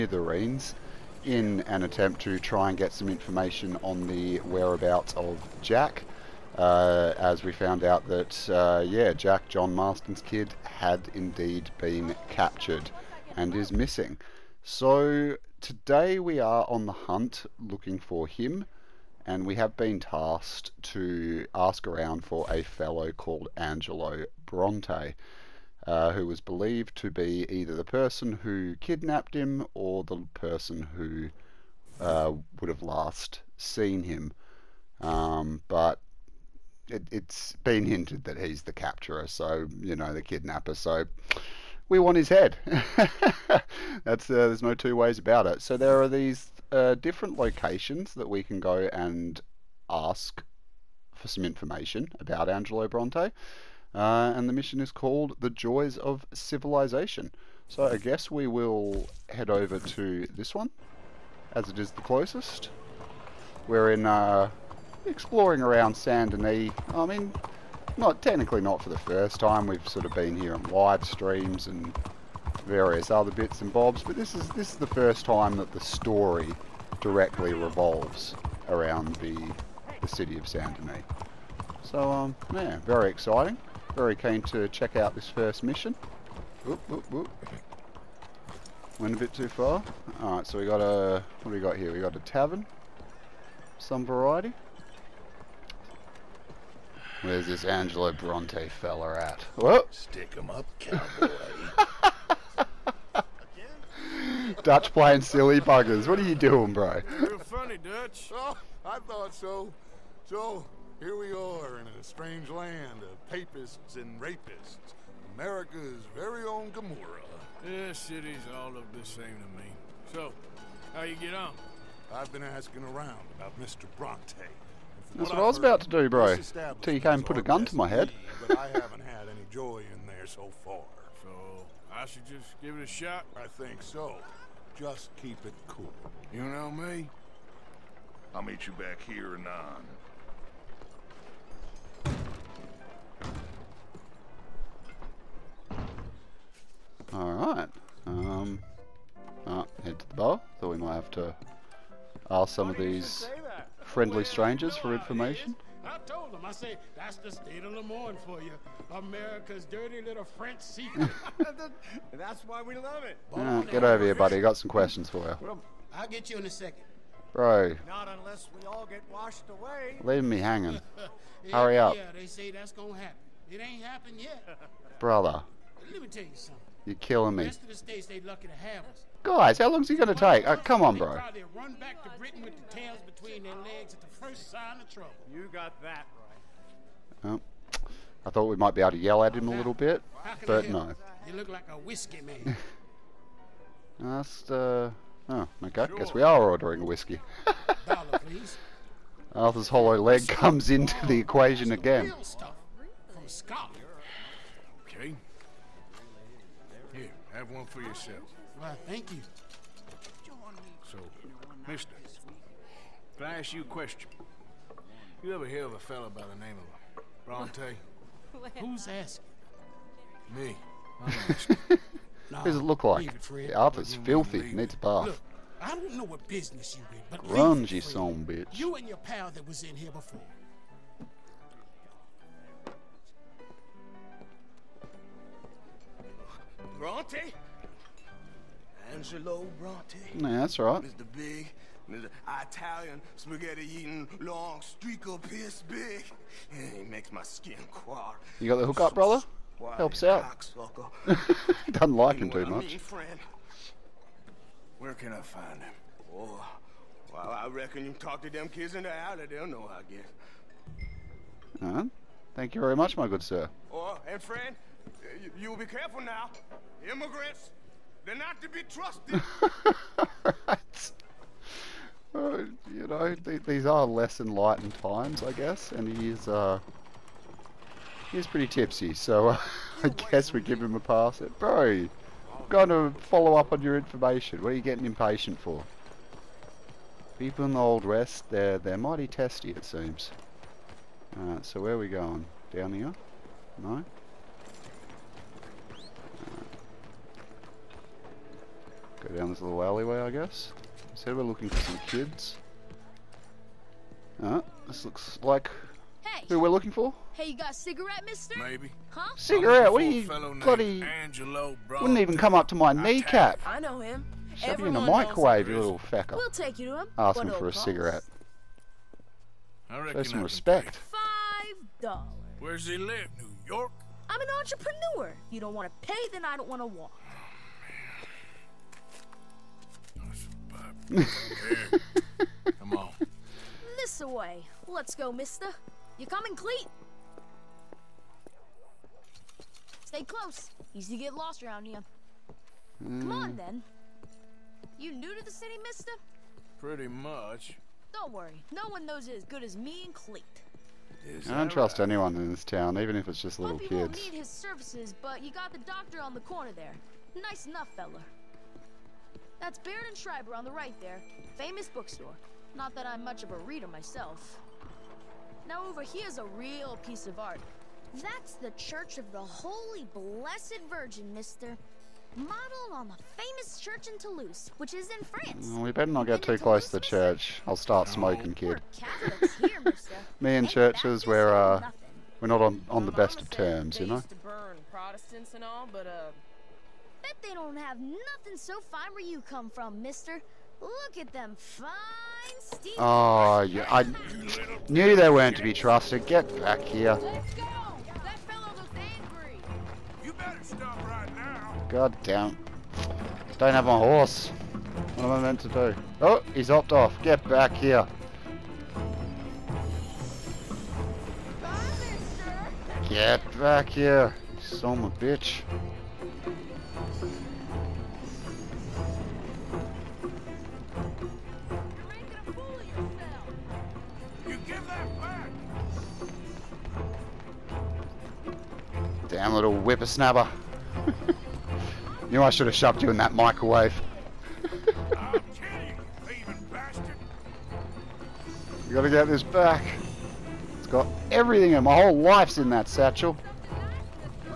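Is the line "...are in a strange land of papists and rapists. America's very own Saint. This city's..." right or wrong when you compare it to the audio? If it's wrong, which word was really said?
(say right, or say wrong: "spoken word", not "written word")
wrong: "Gomorrah", not "Saint".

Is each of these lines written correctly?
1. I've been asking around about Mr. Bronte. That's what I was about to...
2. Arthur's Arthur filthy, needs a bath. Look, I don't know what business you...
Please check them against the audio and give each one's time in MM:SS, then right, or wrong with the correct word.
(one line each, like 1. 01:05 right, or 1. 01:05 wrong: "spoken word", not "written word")
1. 02:02 right
2. 03:43 wrong: "The", not "Arthur".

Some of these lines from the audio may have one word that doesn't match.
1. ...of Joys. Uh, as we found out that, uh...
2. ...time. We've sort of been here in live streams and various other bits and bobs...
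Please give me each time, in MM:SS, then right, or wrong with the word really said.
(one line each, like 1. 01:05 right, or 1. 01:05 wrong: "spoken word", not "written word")
1. 00:05 wrong: "Jack", not "Joys"
2. 01:09 right.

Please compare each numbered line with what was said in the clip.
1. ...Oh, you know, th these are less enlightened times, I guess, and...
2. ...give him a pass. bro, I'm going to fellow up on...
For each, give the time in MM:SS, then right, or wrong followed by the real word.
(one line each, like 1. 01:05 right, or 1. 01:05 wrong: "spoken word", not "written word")
1. 04:32 right
2. 04:40 wrong: "follow", not "fellow".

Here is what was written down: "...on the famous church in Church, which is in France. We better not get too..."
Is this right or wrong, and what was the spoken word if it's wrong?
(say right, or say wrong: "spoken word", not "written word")
wrong: "Toulouse", not "Church".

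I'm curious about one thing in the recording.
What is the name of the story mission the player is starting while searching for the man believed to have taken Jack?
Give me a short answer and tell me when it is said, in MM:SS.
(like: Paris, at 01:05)
The Joys of Civilization, at 00:55.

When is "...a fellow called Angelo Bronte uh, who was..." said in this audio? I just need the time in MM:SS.
00:22.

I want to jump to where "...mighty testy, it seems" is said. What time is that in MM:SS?
04:48.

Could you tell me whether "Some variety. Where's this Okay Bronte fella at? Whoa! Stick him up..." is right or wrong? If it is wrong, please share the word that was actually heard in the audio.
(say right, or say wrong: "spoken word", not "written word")
wrong: "Angelo", not "Okay".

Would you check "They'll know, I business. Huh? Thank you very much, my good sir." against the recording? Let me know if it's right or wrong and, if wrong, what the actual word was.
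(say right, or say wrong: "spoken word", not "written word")
wrong: "guess", not "business".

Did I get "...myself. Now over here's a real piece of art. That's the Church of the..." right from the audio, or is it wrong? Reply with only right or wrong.
right.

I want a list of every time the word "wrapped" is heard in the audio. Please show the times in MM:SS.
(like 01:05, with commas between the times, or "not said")
not said.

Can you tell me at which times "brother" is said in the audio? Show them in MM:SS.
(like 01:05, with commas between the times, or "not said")
02:54, 04:08.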